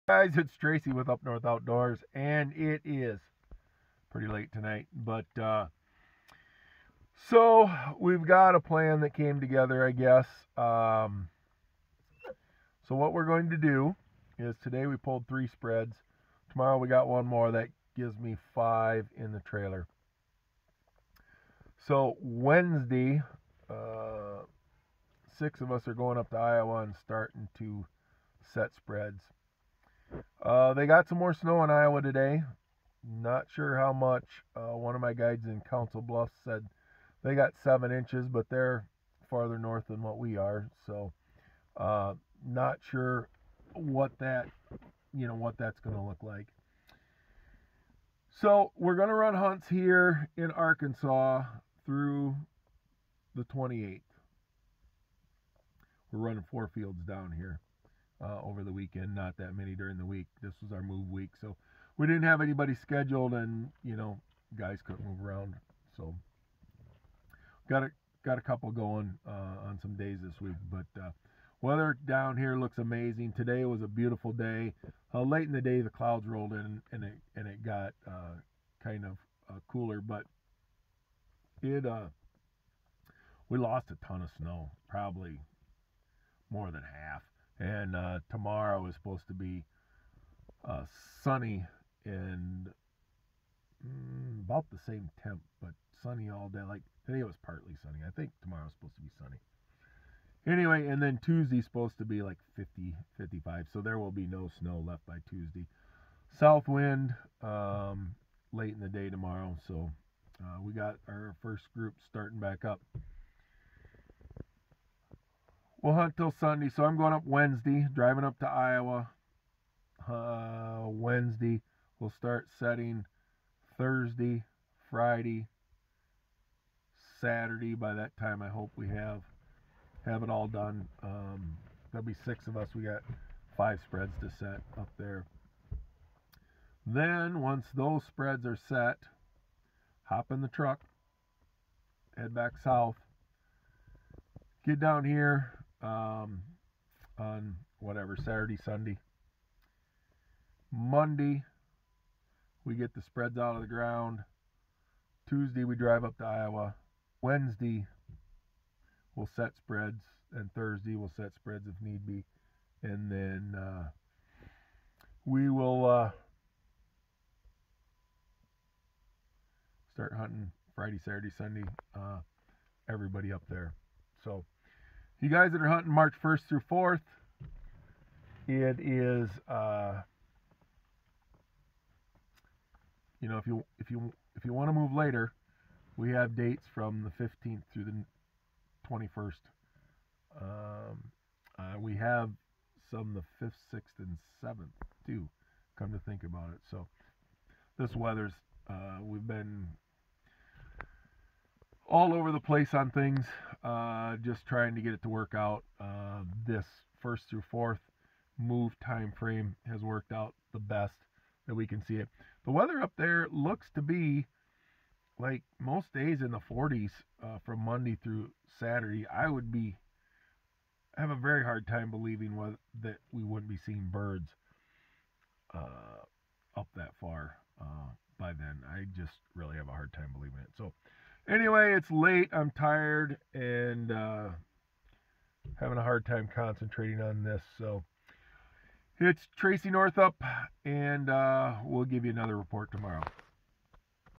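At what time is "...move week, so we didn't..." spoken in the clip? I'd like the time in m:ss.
1:00.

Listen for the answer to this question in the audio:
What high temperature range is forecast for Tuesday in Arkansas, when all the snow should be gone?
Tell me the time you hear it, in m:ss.
1:42.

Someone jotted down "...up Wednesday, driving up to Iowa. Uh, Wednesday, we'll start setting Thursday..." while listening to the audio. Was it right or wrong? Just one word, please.
right.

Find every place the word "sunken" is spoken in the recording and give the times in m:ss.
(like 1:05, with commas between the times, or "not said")
not said.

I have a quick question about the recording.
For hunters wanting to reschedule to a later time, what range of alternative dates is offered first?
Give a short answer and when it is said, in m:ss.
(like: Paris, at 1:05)
15th through 21st, at 3:07.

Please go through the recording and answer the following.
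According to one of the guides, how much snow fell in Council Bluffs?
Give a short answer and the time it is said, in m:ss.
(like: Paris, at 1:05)
7 inches, at 0:37.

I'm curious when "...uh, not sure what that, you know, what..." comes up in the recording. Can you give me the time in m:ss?
0:41.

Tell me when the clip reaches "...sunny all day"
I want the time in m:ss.
1:36.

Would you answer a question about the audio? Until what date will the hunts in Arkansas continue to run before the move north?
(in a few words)
the 28th.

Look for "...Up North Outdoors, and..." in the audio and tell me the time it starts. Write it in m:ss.
0:01.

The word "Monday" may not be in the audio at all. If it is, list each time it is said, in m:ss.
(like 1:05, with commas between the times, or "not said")
2:30, 3:37.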